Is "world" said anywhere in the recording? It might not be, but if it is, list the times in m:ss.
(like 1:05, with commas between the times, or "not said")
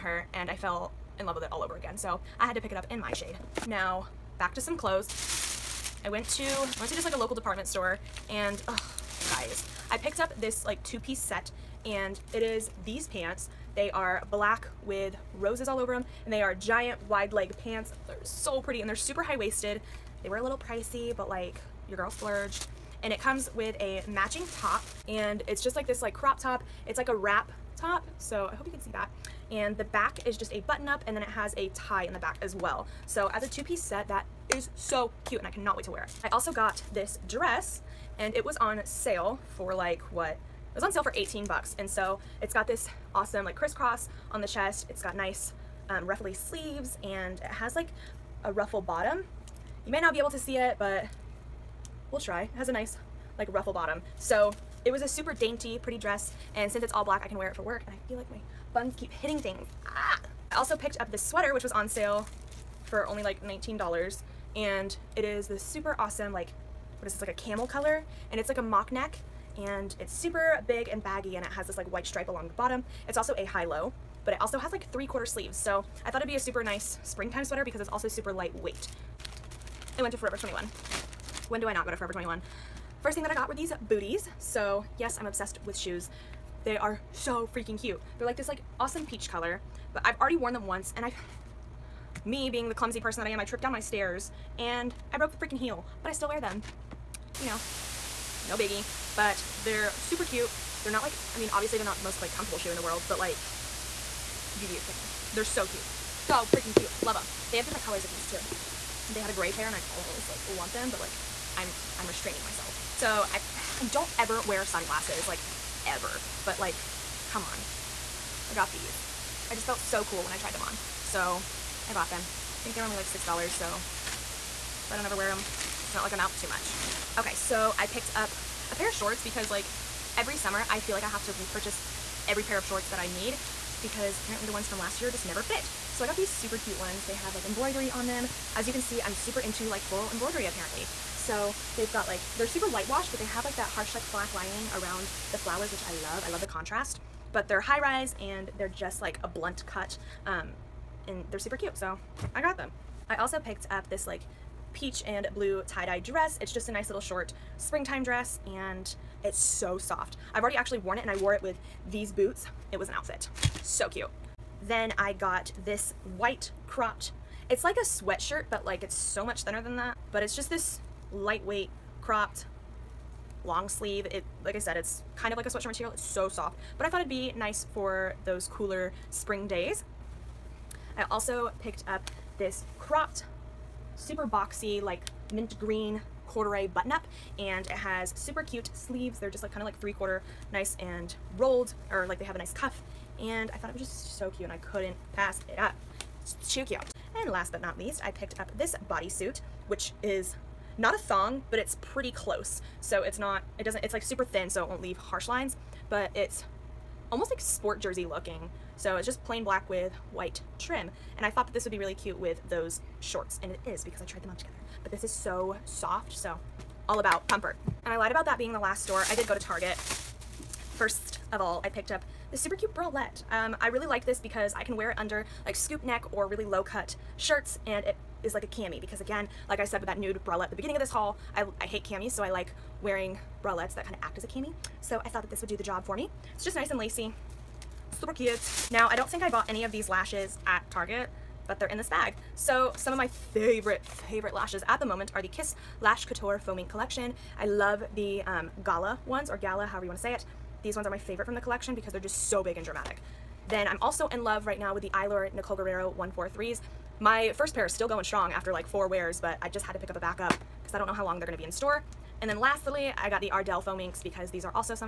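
1:42.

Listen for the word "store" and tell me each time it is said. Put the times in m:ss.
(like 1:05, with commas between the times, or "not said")
0:07, 3:38, 4:21.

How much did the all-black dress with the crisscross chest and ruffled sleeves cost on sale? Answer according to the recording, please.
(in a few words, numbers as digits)
$18.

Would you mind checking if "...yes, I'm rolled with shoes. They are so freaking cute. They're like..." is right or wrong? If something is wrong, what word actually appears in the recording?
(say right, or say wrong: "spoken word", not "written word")
wrong: "obsessed", not "rolled".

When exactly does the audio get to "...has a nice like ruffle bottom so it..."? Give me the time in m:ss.
0:52.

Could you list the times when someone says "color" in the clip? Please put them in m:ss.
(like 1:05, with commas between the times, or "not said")
1:07, 1:29, 1:47.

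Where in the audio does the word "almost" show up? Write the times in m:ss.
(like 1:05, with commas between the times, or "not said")
1:49, 3:27.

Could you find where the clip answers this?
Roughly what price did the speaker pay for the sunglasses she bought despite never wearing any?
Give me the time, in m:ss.
2:03.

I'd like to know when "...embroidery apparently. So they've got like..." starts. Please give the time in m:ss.
2:20.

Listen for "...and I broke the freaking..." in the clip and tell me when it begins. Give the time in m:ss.
1:34.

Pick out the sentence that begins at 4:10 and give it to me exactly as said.
These ones are my favorite from the collection because they're just so big and dramatic.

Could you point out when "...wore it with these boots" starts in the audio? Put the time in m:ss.
2:41.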